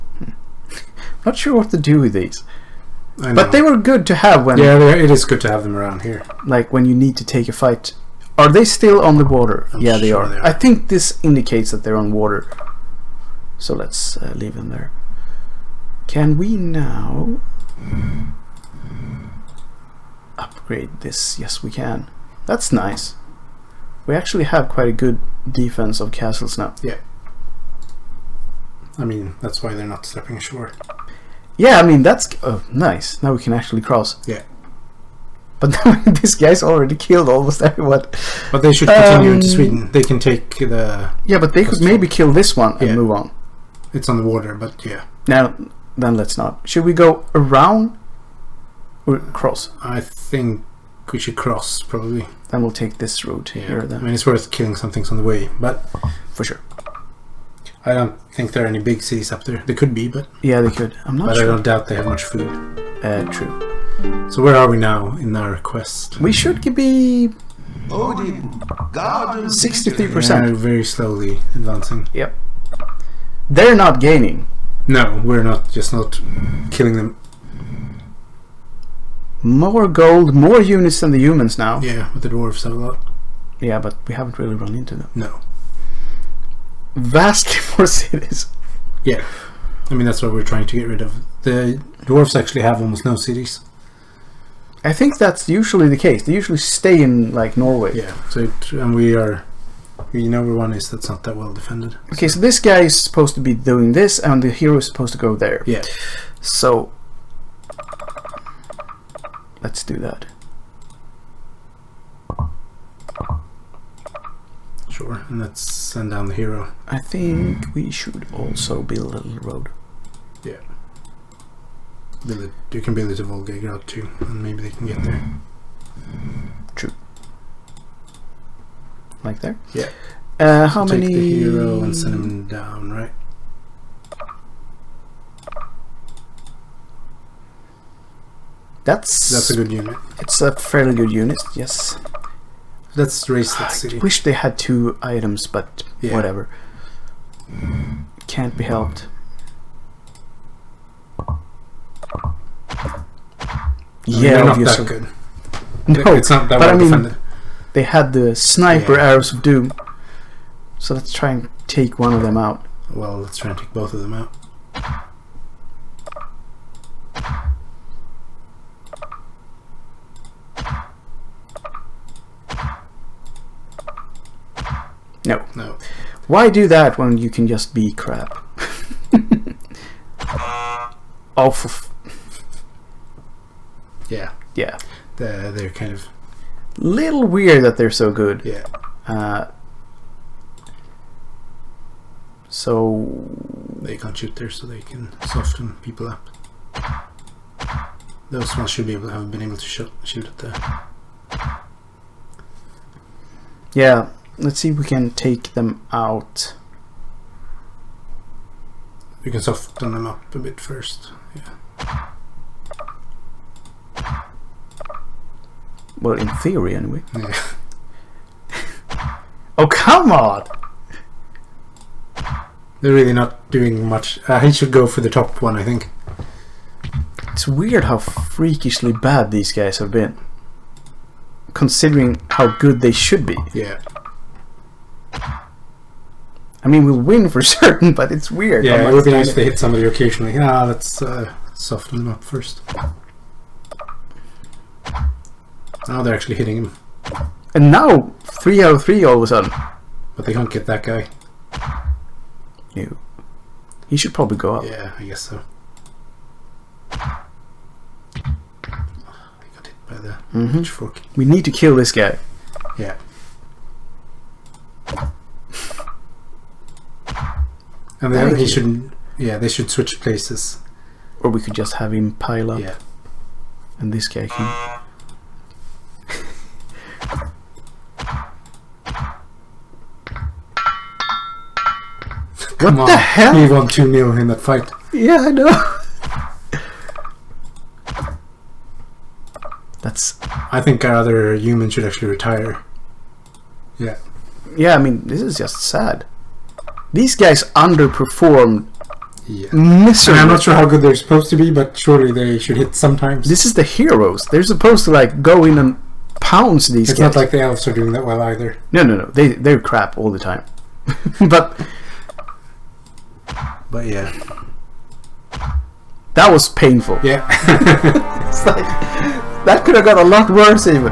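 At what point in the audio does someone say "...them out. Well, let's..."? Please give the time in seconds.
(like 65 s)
162 s.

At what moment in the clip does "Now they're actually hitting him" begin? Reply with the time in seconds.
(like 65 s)
245 s.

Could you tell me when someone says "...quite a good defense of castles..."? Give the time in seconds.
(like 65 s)
24 s.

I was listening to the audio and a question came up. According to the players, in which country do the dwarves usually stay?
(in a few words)
Norway.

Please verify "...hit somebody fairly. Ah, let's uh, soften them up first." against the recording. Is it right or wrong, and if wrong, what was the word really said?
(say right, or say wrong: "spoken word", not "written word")
wrong: "occasionally", not "fairly".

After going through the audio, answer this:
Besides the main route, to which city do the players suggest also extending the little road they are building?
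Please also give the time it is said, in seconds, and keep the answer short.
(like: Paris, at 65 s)
Volgograd, at 123 s.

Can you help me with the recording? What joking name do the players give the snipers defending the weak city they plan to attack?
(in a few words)
arrows of doom.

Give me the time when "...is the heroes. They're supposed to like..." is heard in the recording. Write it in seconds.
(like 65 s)
303 s.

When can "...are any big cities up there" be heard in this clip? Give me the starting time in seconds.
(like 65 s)
58 s.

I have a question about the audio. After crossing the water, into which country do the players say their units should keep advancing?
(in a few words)
Sweden.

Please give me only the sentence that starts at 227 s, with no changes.
It's weird how freakishly bad these guys have been.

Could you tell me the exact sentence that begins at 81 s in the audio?
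Yeah, but the dwarves have a lot.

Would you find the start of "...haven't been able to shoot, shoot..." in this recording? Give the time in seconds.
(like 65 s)
199 s.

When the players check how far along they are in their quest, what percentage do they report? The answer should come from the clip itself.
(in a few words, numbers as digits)
63%.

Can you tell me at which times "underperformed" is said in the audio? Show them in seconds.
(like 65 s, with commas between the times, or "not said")
297 s.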